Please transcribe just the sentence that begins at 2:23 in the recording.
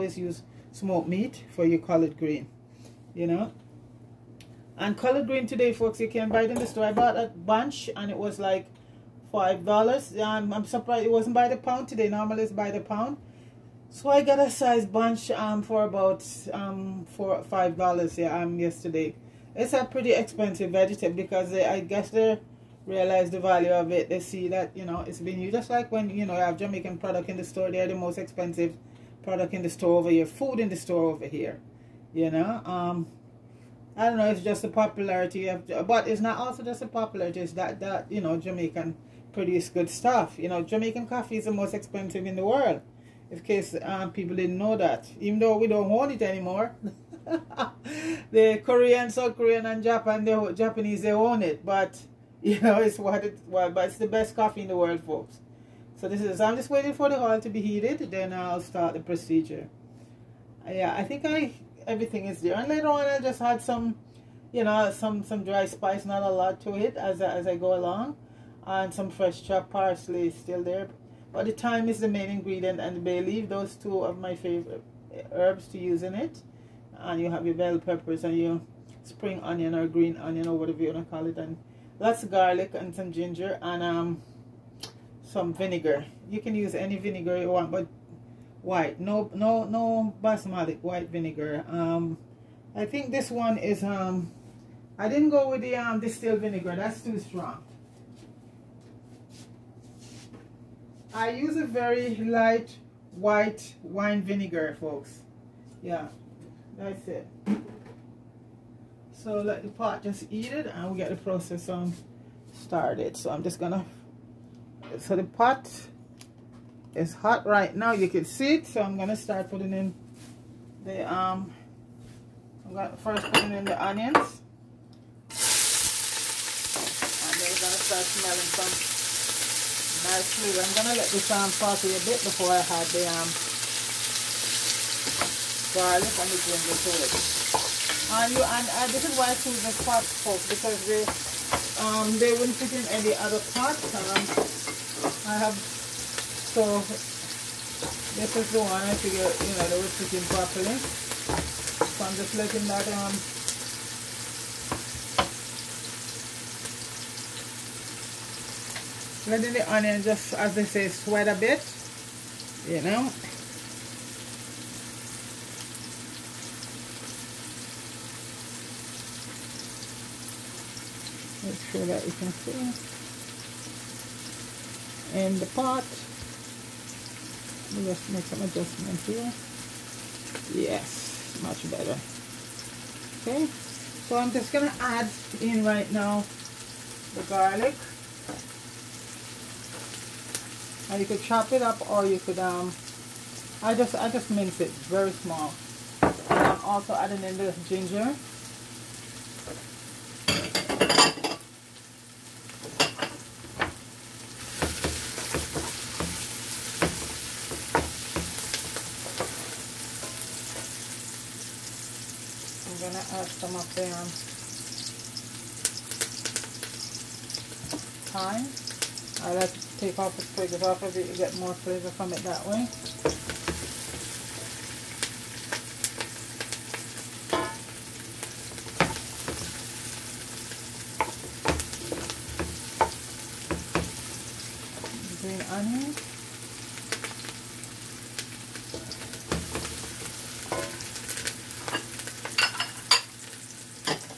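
Um, I have so this is the one I figure you know they would fit in properly.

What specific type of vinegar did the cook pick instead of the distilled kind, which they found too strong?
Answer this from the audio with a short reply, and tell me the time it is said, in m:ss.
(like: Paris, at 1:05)
white wine vinegar, at 1:43.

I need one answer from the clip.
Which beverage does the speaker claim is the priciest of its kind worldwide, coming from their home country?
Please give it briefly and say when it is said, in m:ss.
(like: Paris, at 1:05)
Jamaican coffee, at 0:40.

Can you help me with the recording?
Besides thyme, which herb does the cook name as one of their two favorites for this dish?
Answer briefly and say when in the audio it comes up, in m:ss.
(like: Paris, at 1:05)
bay leaf, at 1:12.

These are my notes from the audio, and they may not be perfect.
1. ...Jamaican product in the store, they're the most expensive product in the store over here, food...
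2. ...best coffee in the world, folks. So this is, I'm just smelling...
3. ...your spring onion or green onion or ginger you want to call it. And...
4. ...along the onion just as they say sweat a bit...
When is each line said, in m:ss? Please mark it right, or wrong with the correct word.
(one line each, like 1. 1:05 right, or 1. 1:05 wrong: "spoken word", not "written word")
1. 0:26 right
2. 0:54 wrong: "waiting", not "smelling"
3. 1:18 wrong: "whatever", not "ginger"
4. 2:39 wrong: "letting", not "along".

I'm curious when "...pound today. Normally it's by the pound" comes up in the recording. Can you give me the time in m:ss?
0:11.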